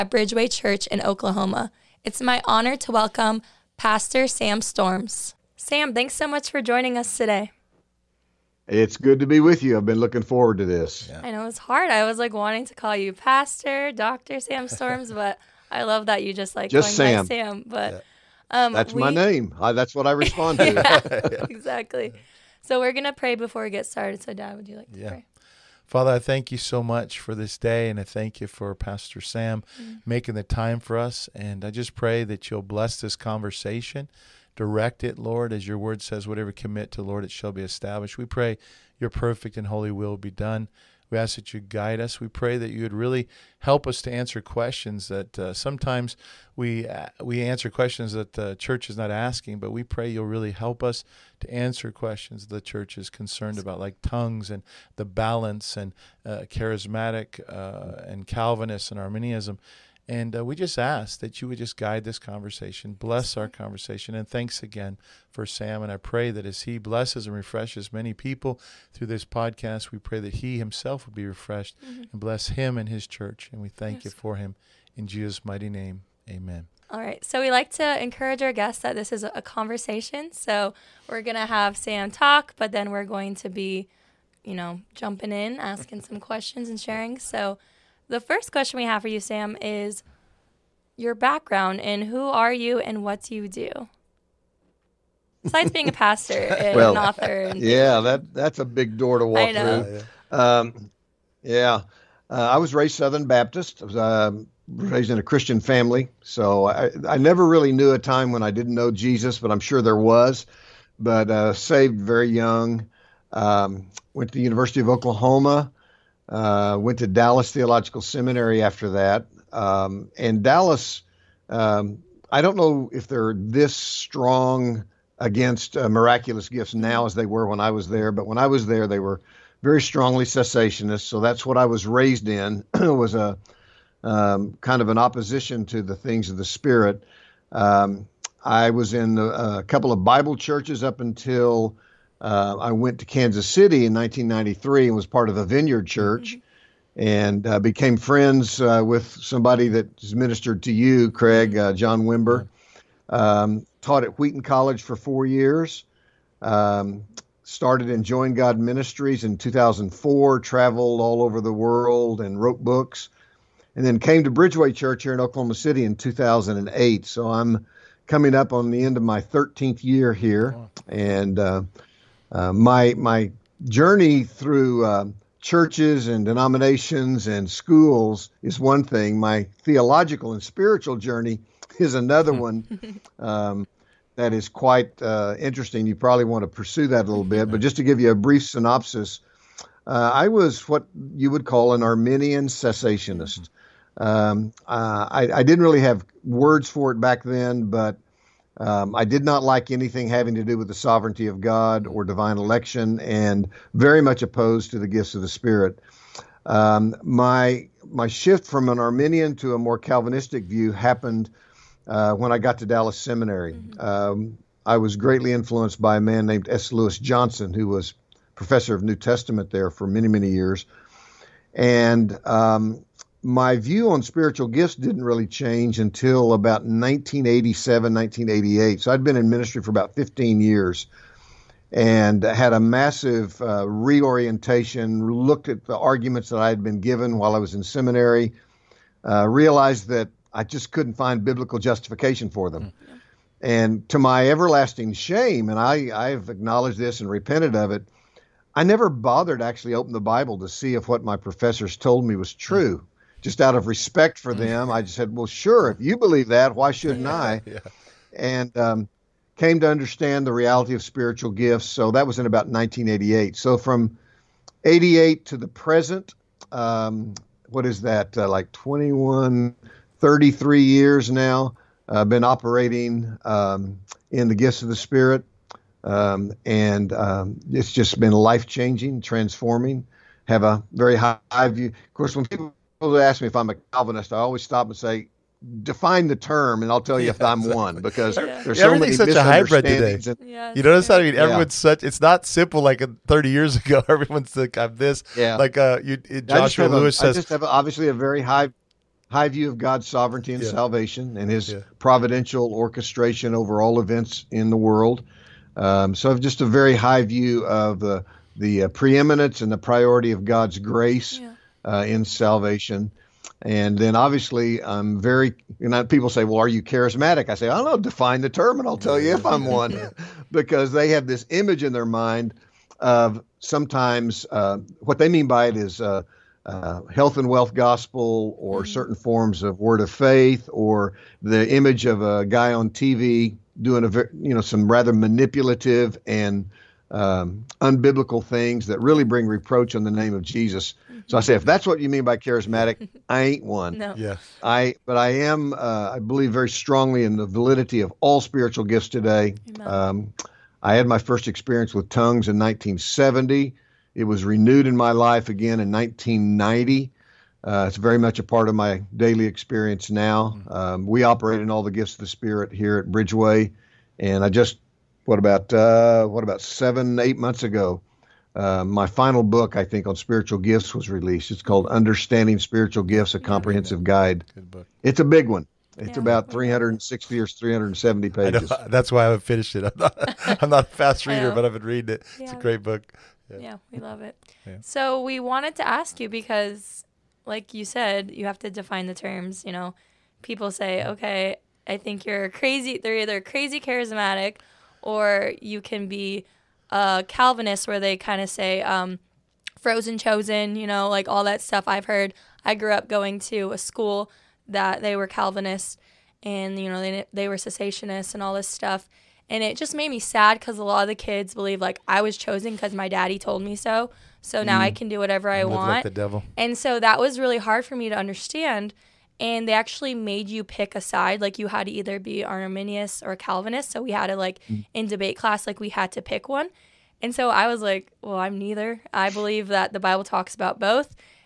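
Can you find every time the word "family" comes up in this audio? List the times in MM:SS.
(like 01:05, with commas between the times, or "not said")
01:45.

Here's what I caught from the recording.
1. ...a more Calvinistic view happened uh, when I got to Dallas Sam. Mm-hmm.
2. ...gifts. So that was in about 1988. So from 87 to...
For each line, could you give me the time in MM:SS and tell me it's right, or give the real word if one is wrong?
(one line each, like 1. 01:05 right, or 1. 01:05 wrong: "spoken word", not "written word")
1. 03:29 wrong: "Seminary", not "Sam"
2. 04:21 wrong: "88", not "87".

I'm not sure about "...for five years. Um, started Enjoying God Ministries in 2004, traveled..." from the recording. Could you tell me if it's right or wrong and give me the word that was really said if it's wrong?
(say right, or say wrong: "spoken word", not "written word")
wrong: "four", not "five".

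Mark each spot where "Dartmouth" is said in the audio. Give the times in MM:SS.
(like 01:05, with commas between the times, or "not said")
not said.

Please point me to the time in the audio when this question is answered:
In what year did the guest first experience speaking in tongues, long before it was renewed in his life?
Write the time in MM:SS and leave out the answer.
05:52.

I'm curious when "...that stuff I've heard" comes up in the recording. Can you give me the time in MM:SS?
06:41.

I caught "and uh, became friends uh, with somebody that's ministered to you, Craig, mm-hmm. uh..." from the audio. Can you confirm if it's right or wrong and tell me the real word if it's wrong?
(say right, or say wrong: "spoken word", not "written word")
right.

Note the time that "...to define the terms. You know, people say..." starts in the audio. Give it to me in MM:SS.
06:28.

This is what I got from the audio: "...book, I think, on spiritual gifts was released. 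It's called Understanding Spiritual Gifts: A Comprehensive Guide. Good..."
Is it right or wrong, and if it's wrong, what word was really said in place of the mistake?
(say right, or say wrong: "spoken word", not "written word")
right.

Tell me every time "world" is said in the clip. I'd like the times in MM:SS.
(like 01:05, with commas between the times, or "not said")
02:41, 05:04.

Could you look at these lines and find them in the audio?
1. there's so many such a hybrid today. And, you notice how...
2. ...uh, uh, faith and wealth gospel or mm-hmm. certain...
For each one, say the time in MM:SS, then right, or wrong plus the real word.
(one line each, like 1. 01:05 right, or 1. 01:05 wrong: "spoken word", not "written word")
1. 04:48 right
2. 05:25 wrong: "health", not "faith".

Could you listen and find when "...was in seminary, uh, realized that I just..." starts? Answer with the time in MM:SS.
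03:57.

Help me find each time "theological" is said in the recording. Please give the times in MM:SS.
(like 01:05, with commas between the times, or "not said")
01:57, 02:59.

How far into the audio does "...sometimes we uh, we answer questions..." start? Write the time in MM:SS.
00:45.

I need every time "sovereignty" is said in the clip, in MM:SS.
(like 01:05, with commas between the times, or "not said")
03:20, 04:59.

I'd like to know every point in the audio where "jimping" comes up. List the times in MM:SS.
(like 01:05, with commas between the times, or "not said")
not said.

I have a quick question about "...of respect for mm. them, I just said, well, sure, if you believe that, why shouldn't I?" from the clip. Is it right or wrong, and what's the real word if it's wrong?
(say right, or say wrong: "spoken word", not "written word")
right.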